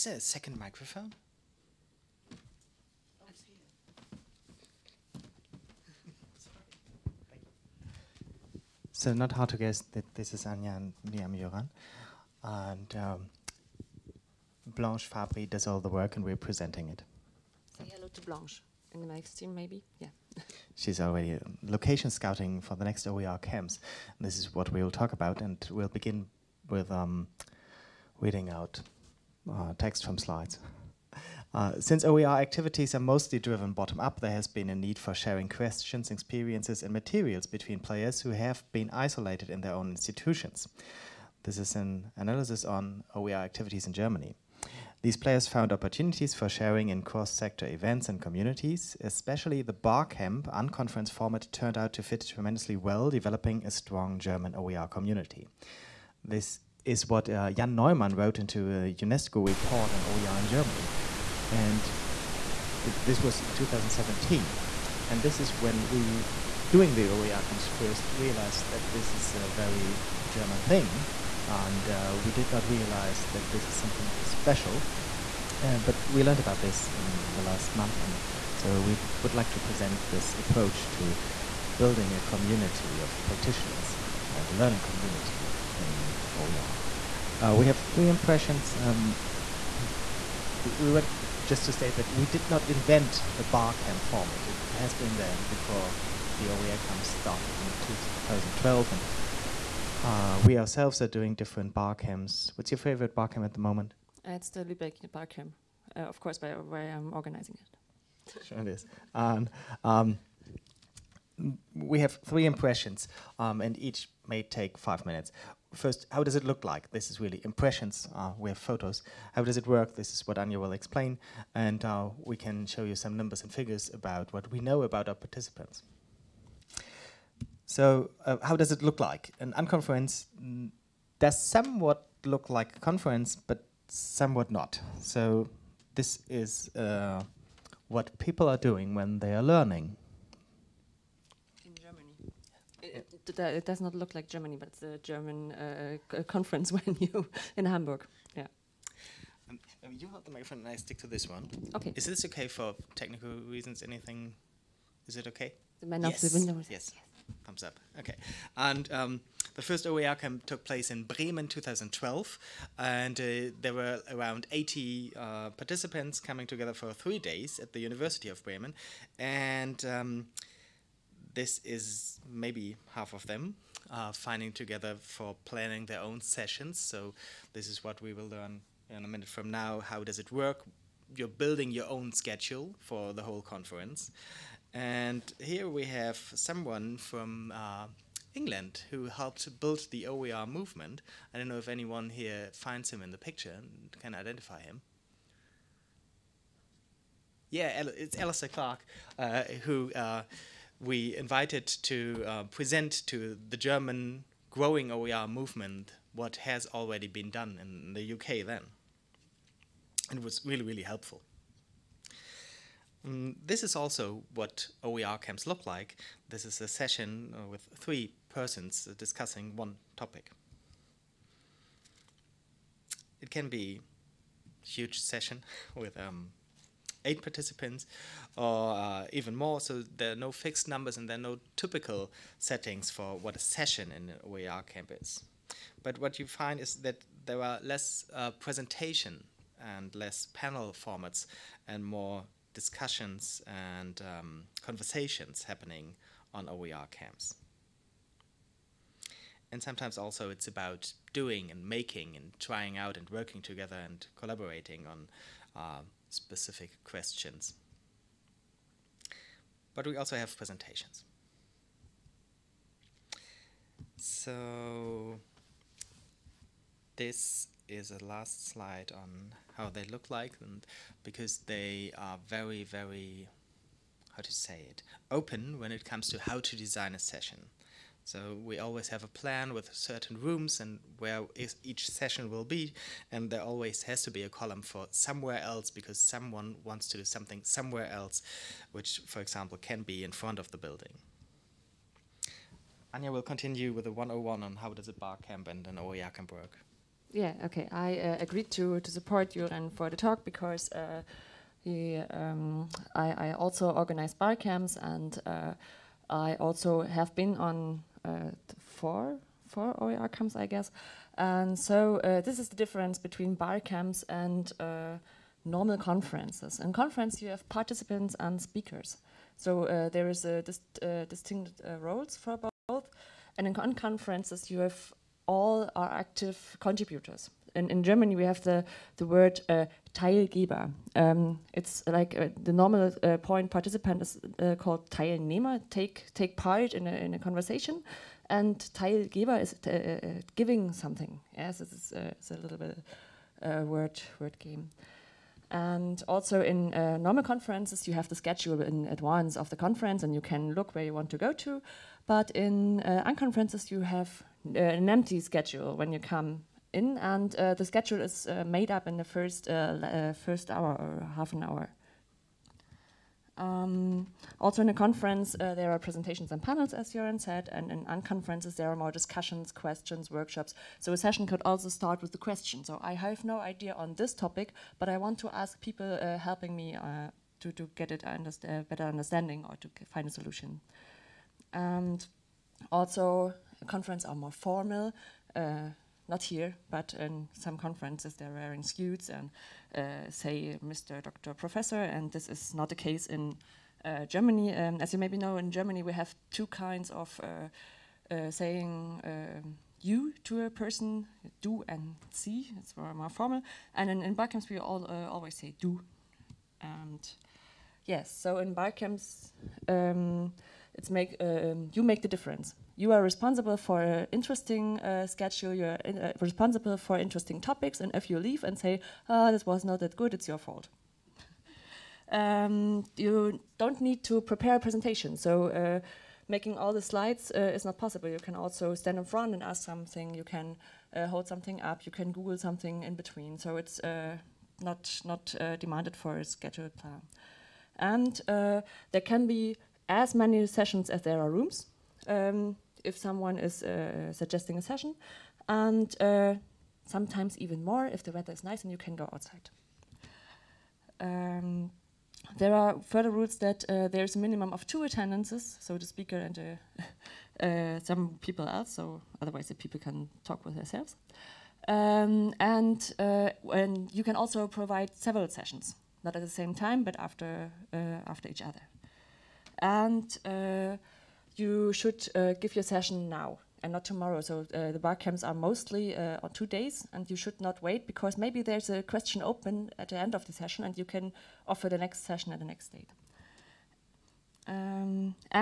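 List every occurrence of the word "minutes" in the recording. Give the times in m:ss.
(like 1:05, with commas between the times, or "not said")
1:55, 2:59.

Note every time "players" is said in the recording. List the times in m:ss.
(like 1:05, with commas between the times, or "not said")
0:37, 0:45.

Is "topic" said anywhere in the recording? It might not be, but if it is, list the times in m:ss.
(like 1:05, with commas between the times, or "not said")
3:39, 6:14, 6:57.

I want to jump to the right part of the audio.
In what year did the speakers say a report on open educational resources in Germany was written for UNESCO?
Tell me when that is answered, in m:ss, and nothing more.
1:03.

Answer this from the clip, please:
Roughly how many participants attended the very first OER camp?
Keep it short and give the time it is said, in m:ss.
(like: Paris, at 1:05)
80, at 2:44.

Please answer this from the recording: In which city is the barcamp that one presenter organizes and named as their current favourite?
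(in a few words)
Lübeck.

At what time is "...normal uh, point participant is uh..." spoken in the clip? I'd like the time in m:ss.
5:32.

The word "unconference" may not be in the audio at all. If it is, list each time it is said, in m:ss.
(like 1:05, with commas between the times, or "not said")
0:50, 2:09, 5:53, 6:07.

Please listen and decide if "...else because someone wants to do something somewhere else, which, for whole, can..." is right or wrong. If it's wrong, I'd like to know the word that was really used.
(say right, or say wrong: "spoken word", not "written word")
wrong: "example", not "whole".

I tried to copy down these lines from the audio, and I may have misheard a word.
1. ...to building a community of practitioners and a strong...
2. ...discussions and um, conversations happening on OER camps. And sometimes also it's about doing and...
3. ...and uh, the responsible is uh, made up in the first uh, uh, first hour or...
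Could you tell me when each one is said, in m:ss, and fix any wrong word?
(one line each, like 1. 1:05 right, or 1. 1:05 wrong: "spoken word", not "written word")
1. 1:20 wrong: "learning", not "strong"
2. 4:02 right
3. 5:56 wrong: "schedule", not "responsible".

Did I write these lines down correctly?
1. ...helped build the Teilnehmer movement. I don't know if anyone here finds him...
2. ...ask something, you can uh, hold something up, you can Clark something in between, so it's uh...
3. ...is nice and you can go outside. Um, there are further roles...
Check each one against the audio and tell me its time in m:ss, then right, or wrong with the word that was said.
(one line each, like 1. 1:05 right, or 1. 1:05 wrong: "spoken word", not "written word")
1. 3:09 wrong: "OER", not "Teilnehmer"
2. 7:09 wrong: "Google", not "Clark"
3. 7:28 wrong: "rules", not "roles".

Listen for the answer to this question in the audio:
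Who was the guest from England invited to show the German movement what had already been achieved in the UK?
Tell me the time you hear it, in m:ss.
3:18.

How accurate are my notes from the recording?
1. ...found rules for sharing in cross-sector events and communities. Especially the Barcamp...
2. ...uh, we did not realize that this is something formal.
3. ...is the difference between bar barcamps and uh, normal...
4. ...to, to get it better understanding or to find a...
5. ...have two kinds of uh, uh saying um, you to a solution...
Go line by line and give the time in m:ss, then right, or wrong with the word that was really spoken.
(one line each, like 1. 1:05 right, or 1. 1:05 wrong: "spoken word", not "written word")
1. 0:45 wrong: "opportunities", not "rules"
2. 1:11 wrong: "special", not "formal"
3. 5:12 wrong: "camps", not "barcamps"
4. 6:17 right
5. 6:35 wrong: "person", not "solution".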